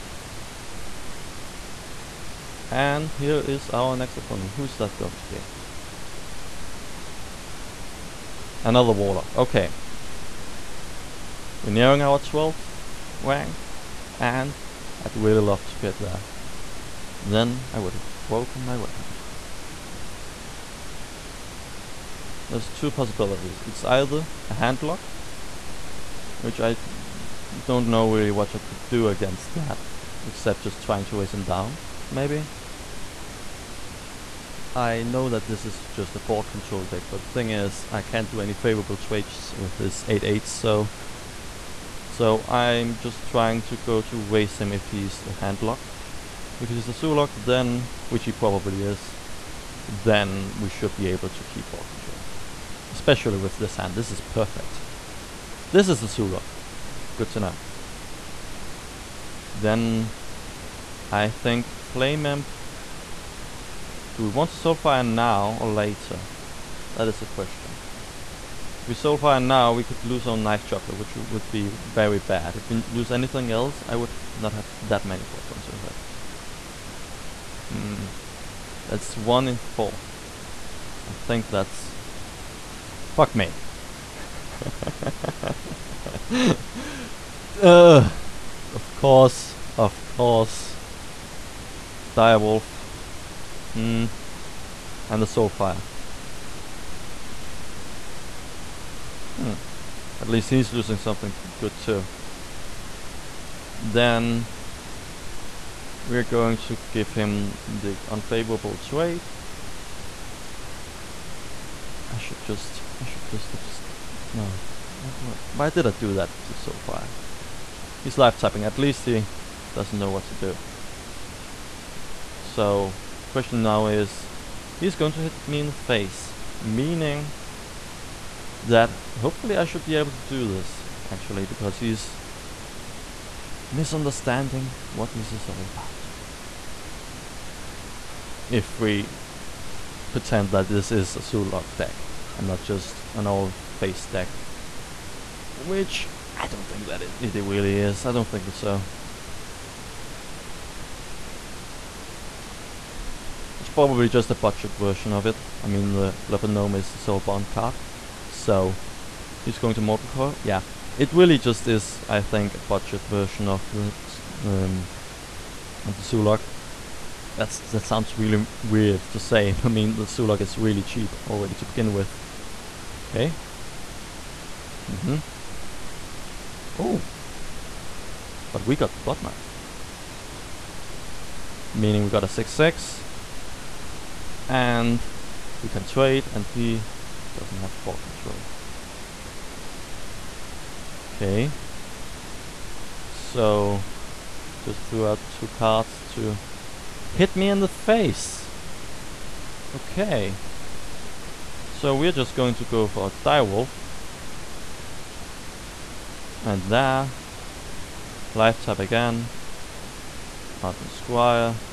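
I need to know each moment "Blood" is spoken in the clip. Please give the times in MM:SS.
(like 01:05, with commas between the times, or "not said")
02:58.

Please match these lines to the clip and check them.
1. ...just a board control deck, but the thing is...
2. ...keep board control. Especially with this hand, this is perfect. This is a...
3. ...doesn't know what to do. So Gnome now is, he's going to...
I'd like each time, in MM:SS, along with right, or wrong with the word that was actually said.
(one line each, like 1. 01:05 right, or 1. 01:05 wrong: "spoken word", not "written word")
1. 00:35 right
2. 00:51 right
3. 01:59 wrong: "Question", not "Gnome".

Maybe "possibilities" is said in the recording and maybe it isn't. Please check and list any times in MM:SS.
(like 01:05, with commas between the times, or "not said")
00:22.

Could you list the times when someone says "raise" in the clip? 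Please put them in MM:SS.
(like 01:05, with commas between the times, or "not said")
00:31, 00:44.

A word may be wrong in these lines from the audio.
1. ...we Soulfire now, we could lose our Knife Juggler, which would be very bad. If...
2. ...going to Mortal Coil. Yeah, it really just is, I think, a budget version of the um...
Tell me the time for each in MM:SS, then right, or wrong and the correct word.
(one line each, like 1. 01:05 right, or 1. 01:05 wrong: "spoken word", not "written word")
1. 01:08 right
2. 02:39 right.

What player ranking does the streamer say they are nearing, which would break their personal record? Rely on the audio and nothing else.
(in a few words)
12th.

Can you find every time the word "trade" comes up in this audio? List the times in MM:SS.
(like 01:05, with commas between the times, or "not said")
00:38, 01:48, 03:05.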